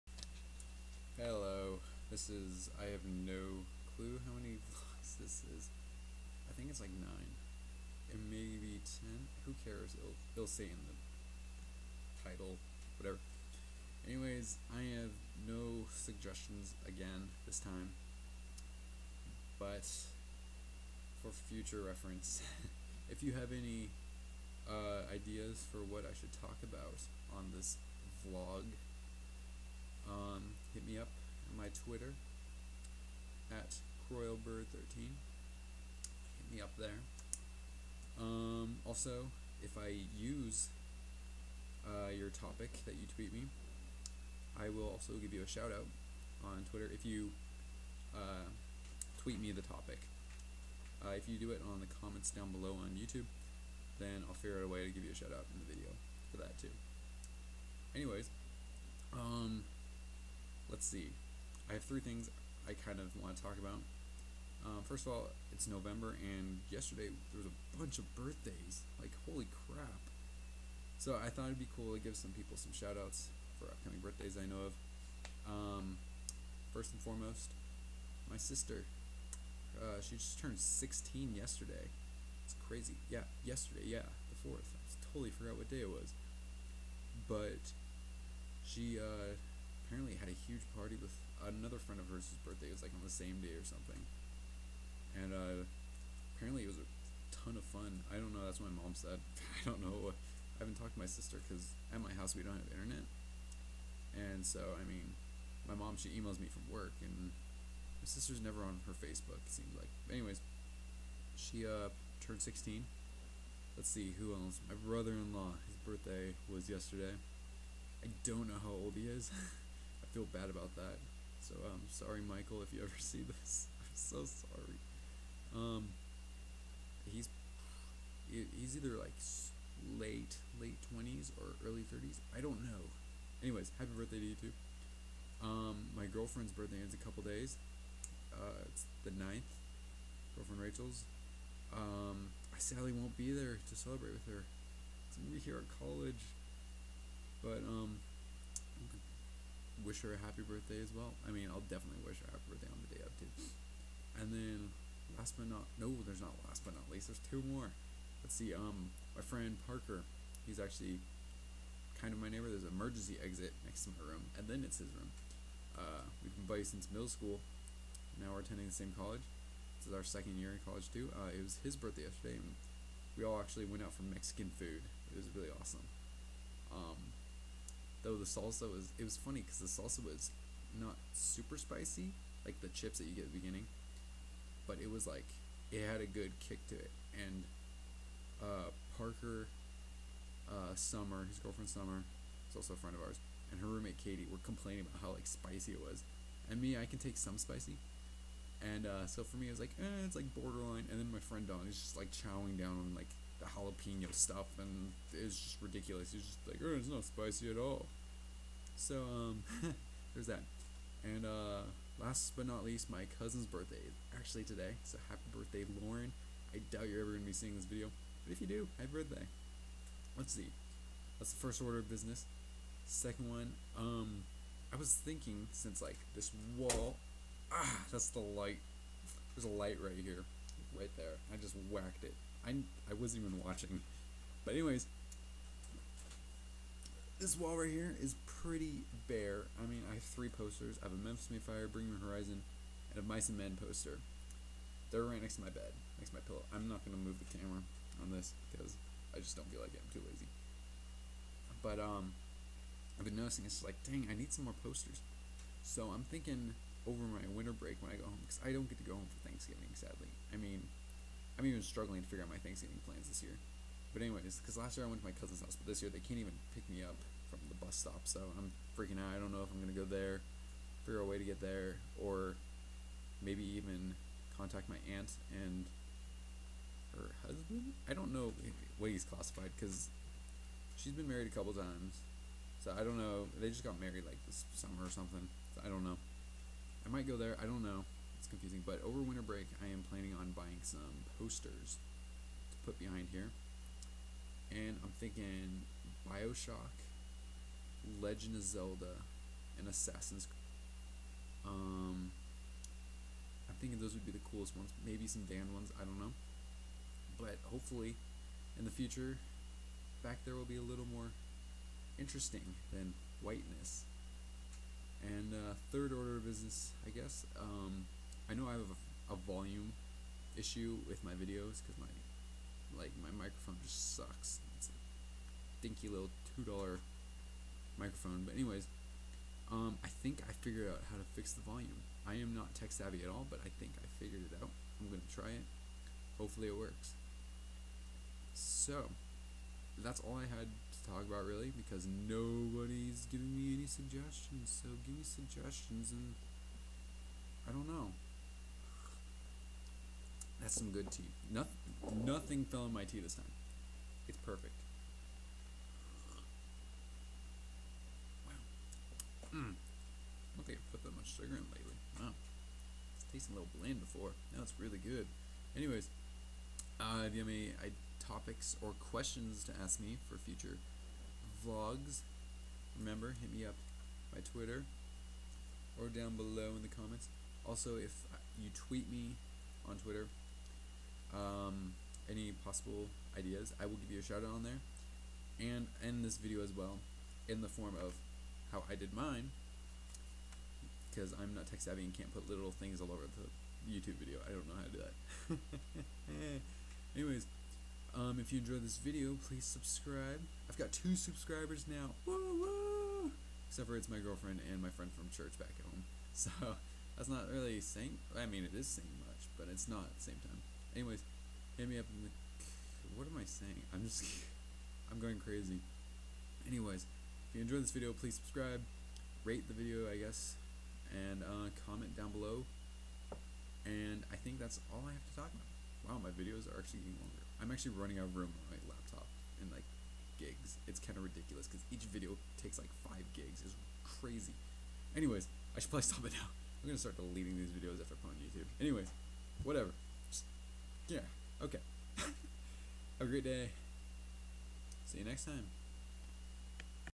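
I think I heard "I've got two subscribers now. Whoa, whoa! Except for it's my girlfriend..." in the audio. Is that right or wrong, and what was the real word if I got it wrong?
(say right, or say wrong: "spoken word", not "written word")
right.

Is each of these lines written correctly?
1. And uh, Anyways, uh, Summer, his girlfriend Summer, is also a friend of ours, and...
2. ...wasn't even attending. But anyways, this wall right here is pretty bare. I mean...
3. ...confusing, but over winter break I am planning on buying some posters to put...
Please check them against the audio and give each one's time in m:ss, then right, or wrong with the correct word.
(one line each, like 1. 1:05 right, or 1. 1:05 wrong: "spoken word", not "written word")
1. 3:07 wrong: "Parker", not "Anyways"
2. 3:52 wrong: "watching", not "attending"
3. 4:48 right.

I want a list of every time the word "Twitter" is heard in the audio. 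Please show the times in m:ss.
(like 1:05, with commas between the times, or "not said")
0:31, 0:46, 6:14, 6:19.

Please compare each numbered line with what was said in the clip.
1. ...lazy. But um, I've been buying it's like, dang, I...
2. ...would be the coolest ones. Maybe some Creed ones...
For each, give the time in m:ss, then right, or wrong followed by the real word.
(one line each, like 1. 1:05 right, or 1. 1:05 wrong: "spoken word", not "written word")
1. 4:10 wrong: "noticing", not "buying"
2. 5:03 wrong: "Dan", not "Creed".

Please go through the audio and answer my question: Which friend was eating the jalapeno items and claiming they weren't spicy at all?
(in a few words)
Don.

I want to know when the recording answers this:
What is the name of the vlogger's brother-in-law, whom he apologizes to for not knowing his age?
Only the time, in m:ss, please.
2:02.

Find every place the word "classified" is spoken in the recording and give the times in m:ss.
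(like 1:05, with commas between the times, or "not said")
4:39.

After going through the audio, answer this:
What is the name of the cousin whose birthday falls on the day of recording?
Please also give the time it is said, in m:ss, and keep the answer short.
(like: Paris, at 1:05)
Lauren, at 3:35.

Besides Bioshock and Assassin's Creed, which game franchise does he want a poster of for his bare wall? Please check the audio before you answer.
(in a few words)
Legend of Zelda.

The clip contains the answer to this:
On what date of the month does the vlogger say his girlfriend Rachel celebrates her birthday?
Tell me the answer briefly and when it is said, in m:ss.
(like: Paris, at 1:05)
9th, at 2:19.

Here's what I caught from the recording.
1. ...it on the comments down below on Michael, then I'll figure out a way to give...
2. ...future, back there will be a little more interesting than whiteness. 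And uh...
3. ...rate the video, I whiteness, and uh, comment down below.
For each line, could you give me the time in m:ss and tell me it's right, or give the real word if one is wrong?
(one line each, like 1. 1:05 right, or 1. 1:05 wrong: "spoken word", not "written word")
1. 0:51 wrong: "YouTube", not "Michael"
2. 5:08 right
3. 6:59 wrong: "guess", not "whiteness".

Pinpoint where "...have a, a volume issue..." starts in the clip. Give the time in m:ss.
5:18.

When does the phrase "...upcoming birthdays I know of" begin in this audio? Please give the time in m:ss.
1:13.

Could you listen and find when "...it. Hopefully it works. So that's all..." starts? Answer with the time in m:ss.
5:35.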